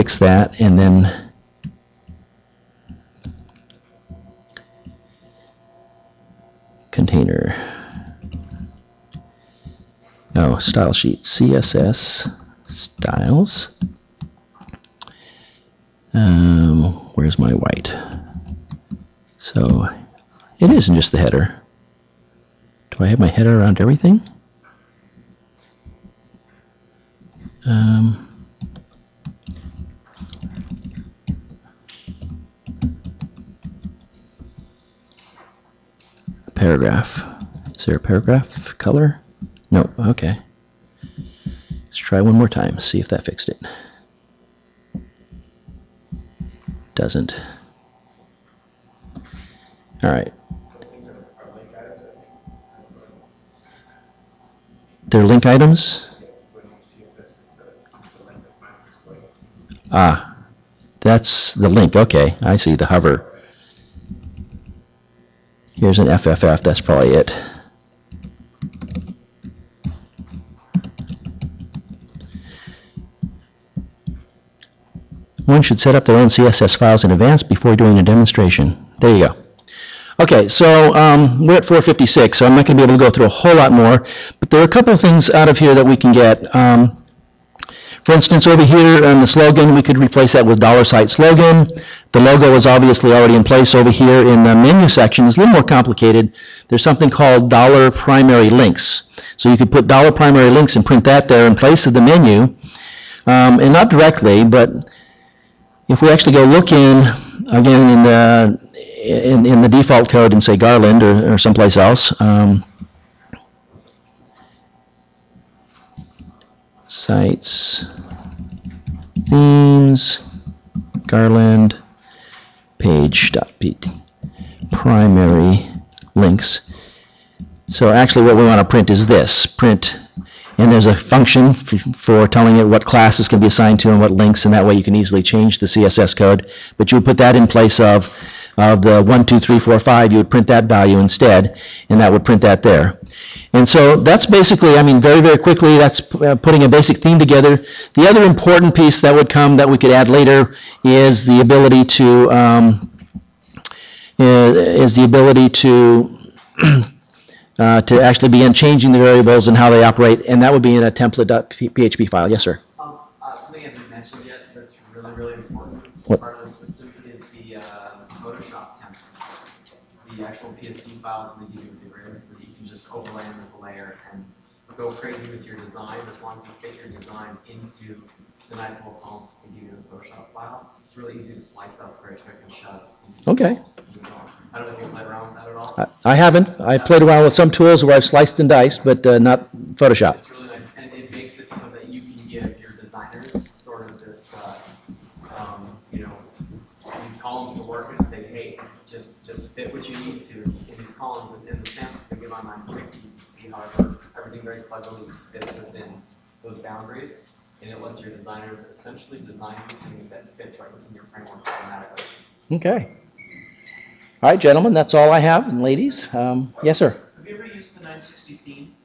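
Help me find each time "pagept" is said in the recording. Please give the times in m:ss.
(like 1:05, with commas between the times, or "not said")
2:02.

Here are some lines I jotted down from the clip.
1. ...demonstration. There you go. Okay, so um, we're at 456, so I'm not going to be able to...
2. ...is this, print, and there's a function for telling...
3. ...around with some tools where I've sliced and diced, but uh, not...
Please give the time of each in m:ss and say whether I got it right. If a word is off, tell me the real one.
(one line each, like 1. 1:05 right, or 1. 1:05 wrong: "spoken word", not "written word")
1. 1:18 right
2. 2:08 right
3. 3:07 right.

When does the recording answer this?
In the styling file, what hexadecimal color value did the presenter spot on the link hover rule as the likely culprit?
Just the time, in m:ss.
1:06.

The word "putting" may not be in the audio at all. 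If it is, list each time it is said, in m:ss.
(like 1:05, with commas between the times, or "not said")
2:26.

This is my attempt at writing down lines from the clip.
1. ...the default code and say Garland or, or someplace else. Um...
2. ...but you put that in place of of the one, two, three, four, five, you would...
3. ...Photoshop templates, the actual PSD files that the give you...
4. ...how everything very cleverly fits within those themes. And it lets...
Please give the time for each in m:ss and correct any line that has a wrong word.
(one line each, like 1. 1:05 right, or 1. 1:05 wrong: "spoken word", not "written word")
1. 1:49 right
2. 2:16 right
3. 2:48 right
4. 3:23 wrong: "boundaries", not "themes".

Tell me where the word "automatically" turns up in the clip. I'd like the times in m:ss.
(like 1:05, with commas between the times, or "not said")
3:31.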